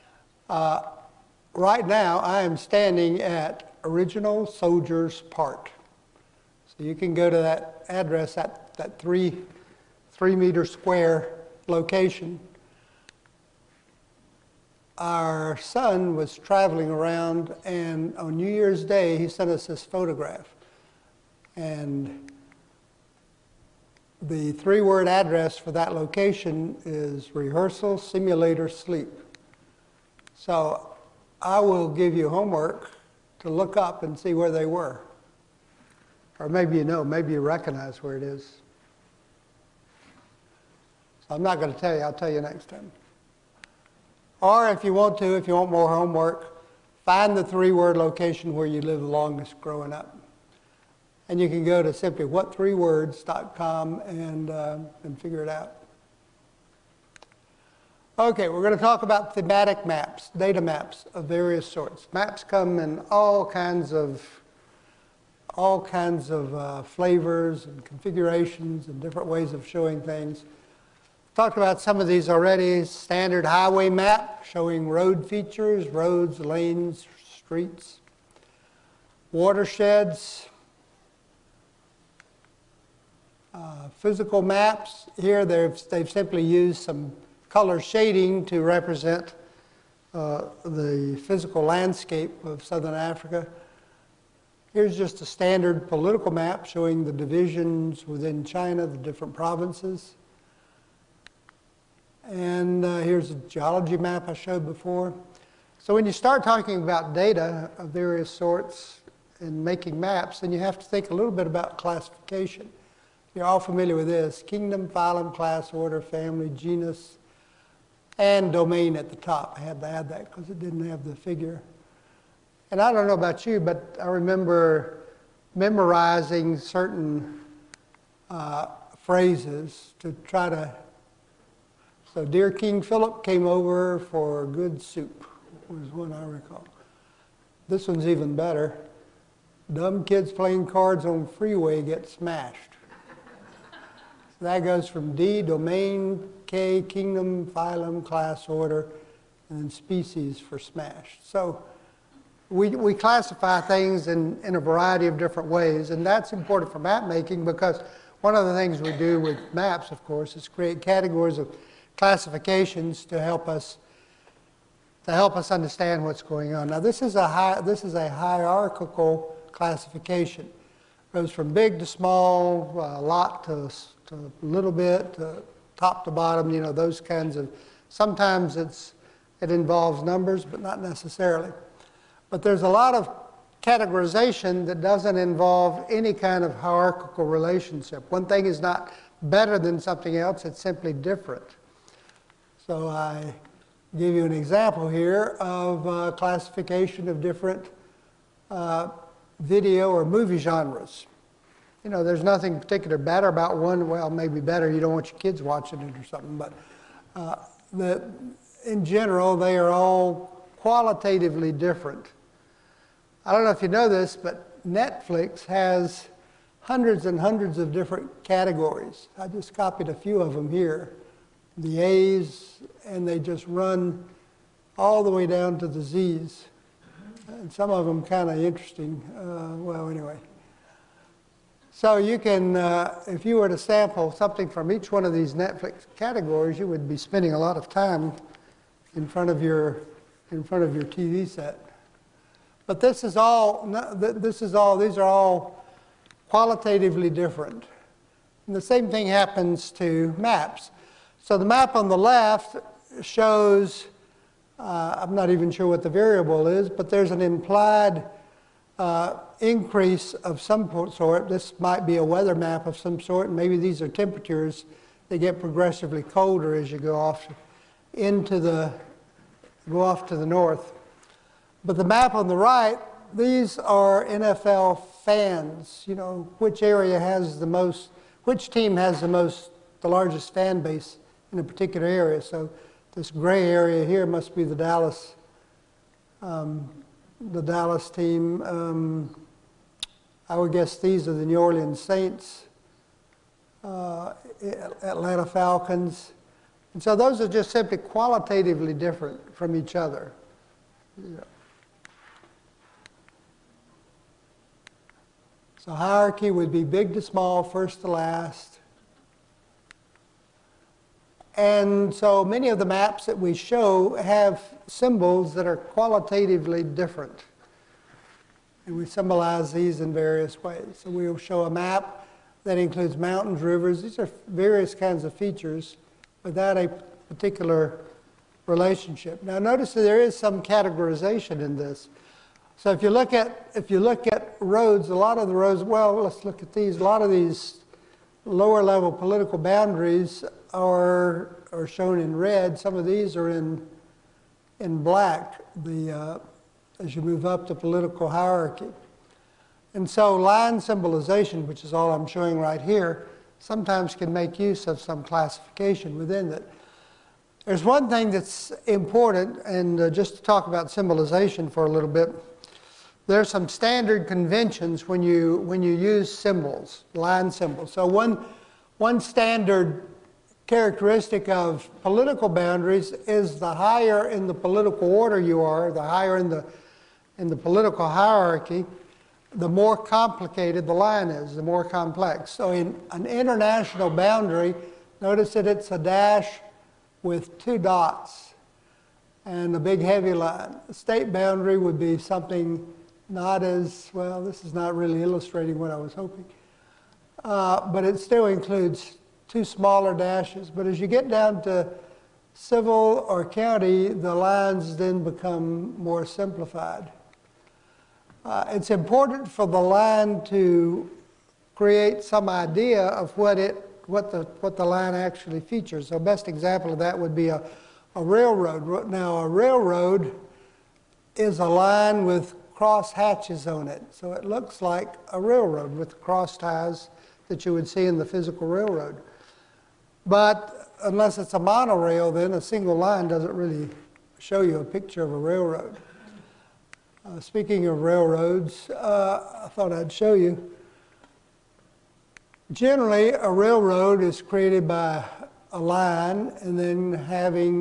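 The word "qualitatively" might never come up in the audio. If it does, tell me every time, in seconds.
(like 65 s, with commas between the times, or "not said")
210 s, 246 s, 297 s, 315 s.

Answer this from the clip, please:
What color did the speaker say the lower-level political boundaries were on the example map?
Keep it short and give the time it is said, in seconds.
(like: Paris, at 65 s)
red, at 342 s.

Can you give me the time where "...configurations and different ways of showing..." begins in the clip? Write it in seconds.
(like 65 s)
67 s.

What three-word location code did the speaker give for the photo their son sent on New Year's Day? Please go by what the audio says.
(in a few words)
rehearsal simulator sleep.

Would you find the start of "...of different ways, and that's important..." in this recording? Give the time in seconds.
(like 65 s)
155 s.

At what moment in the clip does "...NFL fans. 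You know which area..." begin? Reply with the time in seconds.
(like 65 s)
274 s.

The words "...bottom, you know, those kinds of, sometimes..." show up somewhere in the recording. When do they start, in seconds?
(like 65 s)
176 s.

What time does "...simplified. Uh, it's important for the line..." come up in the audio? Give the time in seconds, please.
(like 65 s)
406 s.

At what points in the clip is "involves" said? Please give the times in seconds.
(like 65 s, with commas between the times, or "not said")
179 s, 185 s.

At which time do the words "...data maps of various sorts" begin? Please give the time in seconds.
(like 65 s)
60 s.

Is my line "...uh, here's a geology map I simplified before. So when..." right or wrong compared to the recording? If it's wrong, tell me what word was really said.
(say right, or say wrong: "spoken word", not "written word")
wrong: "showed", not "simplified".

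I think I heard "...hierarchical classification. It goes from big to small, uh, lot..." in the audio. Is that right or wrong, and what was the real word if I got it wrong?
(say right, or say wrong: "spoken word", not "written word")
right.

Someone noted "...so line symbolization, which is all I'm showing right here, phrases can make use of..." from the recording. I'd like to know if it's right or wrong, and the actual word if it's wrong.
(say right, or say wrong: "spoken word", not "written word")
wrong: "sometimes", not "phrases".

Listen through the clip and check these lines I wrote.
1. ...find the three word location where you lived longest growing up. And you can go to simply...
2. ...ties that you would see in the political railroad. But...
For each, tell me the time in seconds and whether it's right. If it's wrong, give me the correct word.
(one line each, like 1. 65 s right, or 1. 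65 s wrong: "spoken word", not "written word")
1. 47 s right
2. 426 s wrong: "physical", not "political".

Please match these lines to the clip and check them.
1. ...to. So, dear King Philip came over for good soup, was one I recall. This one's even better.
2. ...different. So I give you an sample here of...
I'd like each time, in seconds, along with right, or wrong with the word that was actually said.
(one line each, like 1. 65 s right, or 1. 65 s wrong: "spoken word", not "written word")
1. 130 s right
2. 190 s wrong: "example", not "sample".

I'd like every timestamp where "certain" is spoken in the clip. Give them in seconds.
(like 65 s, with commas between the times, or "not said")
126 s.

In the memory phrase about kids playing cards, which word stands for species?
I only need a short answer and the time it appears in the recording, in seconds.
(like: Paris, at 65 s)
smashed, at 142 s.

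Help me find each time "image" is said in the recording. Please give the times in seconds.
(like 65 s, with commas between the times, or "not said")
not said.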